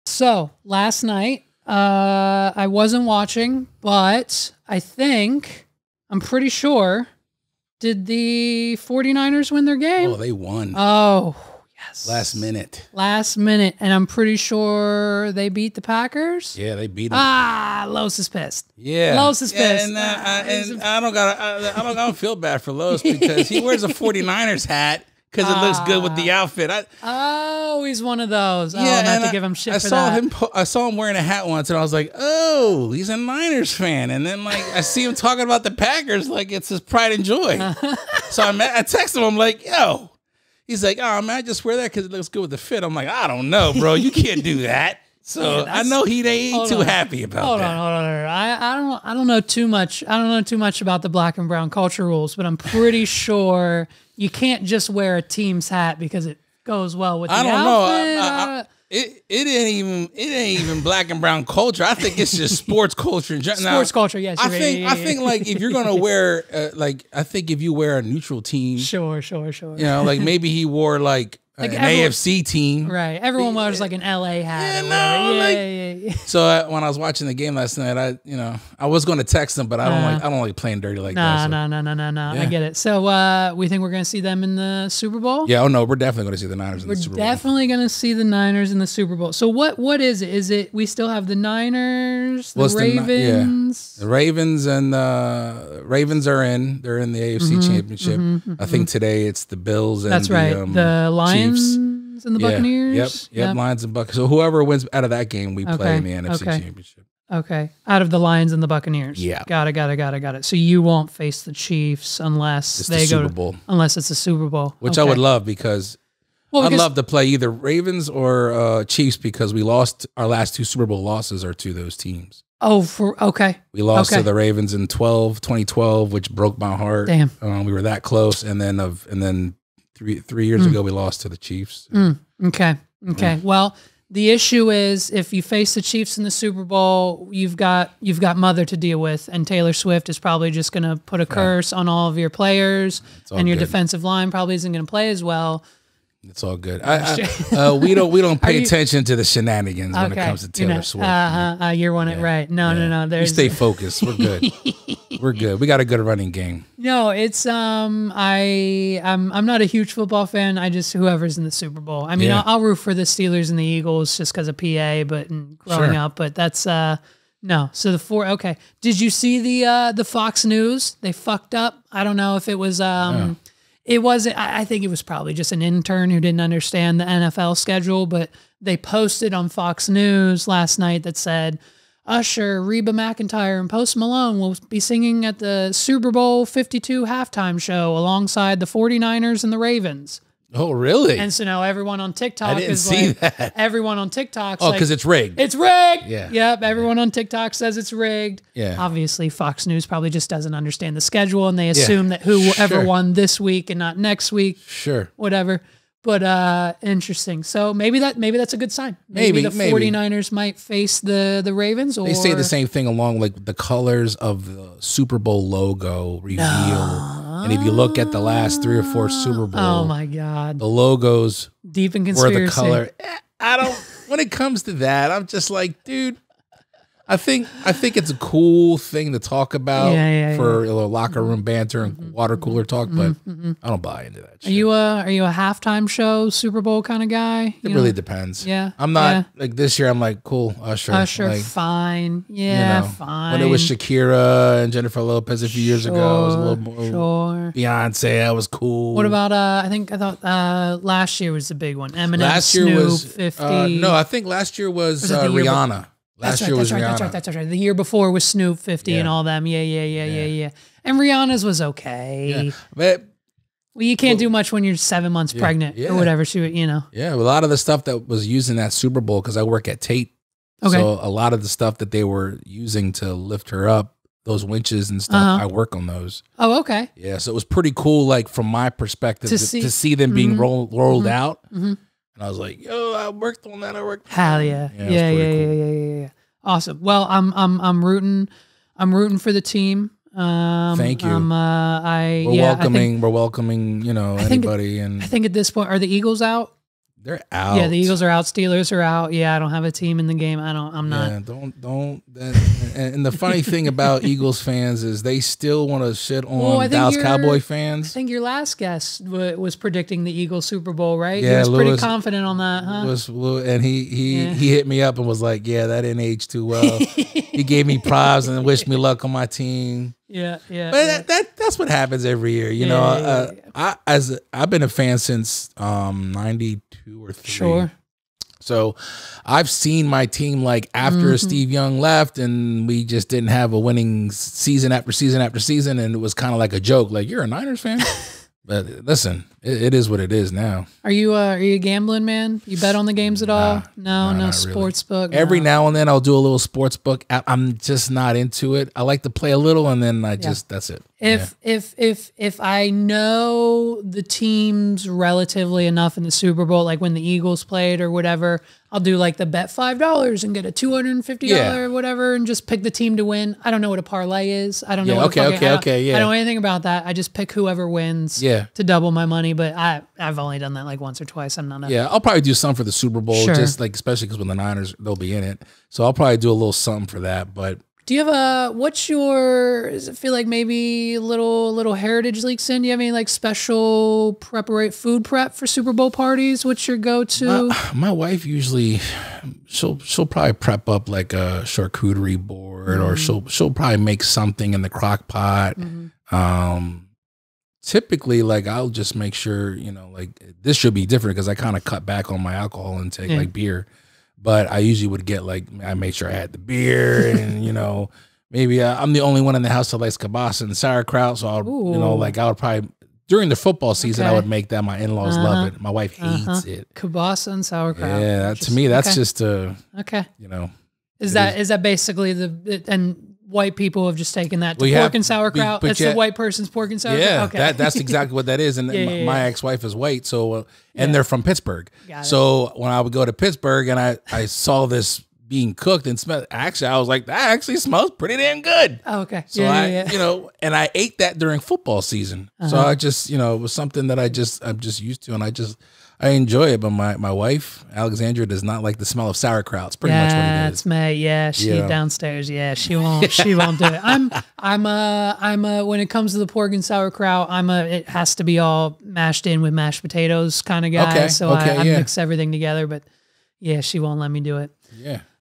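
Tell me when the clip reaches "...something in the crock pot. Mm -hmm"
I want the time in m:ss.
6:34.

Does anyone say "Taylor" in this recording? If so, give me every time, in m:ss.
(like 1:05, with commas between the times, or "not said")
2:19, 2:30.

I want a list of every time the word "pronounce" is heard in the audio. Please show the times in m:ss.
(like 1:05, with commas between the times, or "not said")
not said.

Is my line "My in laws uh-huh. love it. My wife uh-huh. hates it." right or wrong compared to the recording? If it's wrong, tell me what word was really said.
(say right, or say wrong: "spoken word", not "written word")
right.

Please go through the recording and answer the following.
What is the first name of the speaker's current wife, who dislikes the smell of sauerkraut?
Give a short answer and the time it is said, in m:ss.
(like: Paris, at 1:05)
Alexandra, at 7:27.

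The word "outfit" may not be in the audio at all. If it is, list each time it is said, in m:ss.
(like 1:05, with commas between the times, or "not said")
0:26, 0:57.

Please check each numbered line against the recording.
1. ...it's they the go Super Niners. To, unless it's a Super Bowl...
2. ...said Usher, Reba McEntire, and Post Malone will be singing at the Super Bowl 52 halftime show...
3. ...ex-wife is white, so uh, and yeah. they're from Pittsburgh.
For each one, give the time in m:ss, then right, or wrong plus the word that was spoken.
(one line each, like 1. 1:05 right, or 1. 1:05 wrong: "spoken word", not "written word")
1. 1:52 wrong: "Bowl", not "Niners"
2. 3:01 right
3. 7:09 right.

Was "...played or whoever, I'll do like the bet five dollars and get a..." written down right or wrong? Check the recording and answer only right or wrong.
wrong.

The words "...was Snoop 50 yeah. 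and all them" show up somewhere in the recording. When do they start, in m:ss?
4:18.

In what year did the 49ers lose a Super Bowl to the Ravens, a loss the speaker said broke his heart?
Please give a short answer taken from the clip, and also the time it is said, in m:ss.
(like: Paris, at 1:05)
2012, at 2:05.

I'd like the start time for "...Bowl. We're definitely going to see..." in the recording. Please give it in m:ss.
1:27.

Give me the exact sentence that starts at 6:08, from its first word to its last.
to double my money, but I I've only done that like once or twice.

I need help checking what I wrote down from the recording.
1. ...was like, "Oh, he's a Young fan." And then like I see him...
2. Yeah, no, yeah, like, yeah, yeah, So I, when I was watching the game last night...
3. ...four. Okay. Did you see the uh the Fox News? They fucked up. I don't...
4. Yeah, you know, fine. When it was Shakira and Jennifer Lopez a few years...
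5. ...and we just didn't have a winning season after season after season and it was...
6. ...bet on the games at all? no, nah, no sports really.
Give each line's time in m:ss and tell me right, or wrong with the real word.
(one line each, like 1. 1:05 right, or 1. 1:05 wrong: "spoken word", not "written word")
1. 0:31 wrong: "Niners", not "Young"
2. 1:14 right
3. 2:47 right
4. 4:02 right
5. 5:32 right
6. 5:42 right.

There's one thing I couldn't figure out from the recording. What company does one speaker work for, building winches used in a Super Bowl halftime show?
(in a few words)
Tait.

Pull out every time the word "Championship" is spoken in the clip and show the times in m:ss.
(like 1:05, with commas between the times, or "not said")
1:37, 1:46.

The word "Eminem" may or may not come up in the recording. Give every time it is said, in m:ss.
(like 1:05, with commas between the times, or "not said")
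4:12.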